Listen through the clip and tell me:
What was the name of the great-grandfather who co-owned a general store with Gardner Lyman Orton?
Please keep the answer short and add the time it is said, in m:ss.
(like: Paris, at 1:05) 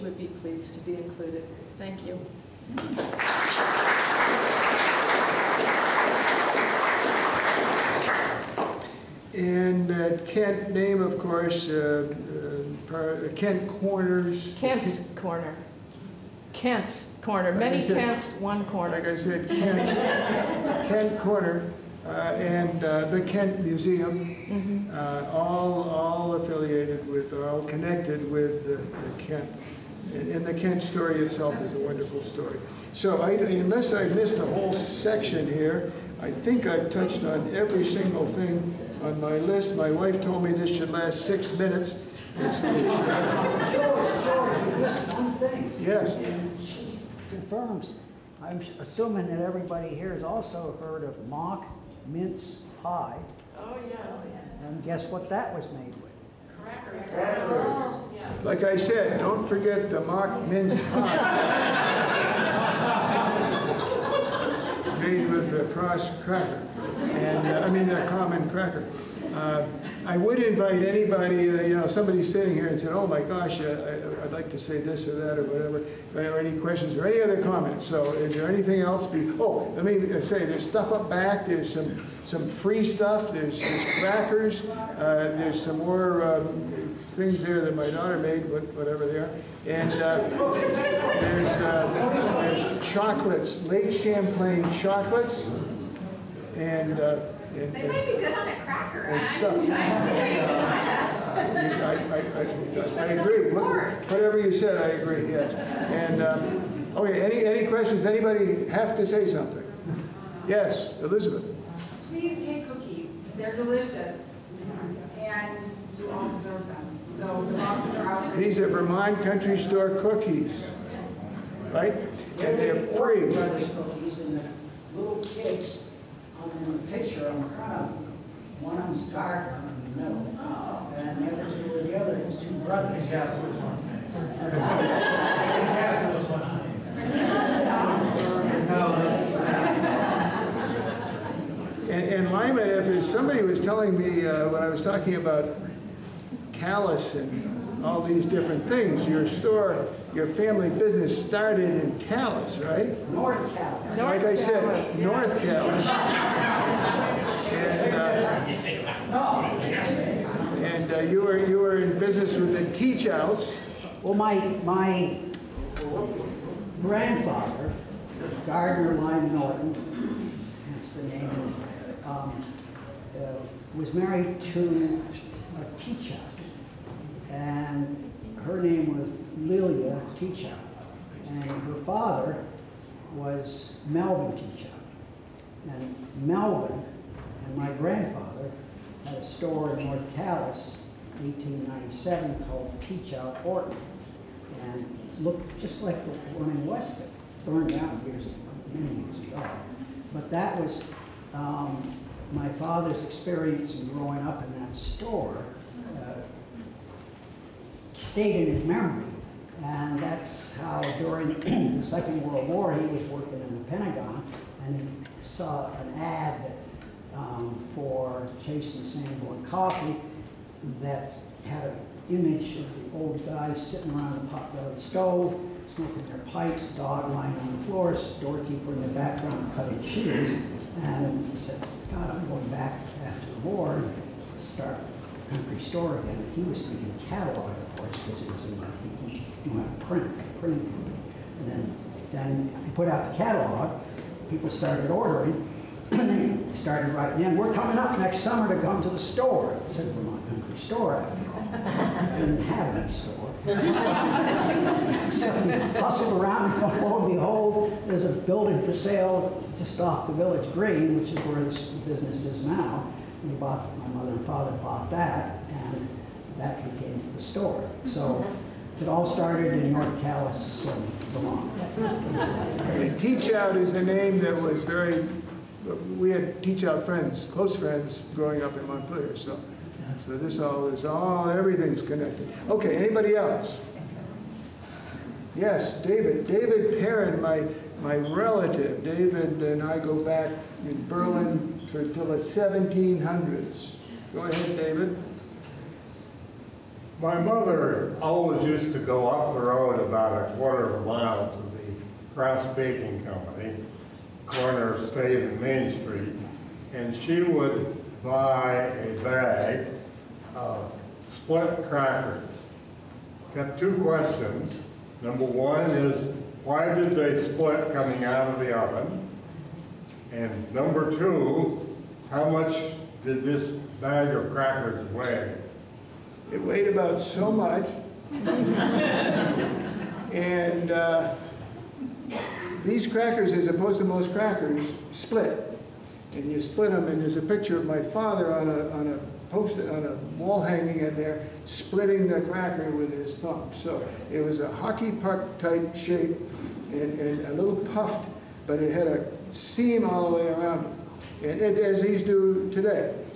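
Melvin Teachout, at 3:03.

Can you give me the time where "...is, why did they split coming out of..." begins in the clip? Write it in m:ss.
5:15.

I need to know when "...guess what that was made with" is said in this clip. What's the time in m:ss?
0:54.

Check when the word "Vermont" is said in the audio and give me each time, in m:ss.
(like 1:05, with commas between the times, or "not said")
1:58, 4:09, 4:31.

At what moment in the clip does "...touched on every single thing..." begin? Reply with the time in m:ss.
0:36.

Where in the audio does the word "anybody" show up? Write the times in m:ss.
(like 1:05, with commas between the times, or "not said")
1:10, 1:48, 4:42.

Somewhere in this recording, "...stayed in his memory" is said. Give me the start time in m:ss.
3:28.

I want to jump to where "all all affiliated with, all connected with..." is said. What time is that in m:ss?
0:25.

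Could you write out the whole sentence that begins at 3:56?
He was thinking catalog course, questions into my, do to print, print.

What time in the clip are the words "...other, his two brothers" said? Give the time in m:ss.
2:11.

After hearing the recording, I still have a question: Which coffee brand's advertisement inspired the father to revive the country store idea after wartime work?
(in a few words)
Chase and Sanborn.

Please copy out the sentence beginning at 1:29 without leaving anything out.
And uh, there's, uh, there's chocolates, Lake Champlain chocolates and, uh, and they might be good on a cracker.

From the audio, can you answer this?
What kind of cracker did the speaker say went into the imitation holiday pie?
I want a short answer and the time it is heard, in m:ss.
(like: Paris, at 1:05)
common cracker, at 1:07.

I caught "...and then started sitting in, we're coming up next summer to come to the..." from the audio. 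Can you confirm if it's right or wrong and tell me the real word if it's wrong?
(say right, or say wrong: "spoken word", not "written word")
wrong: "writing", not "sitting".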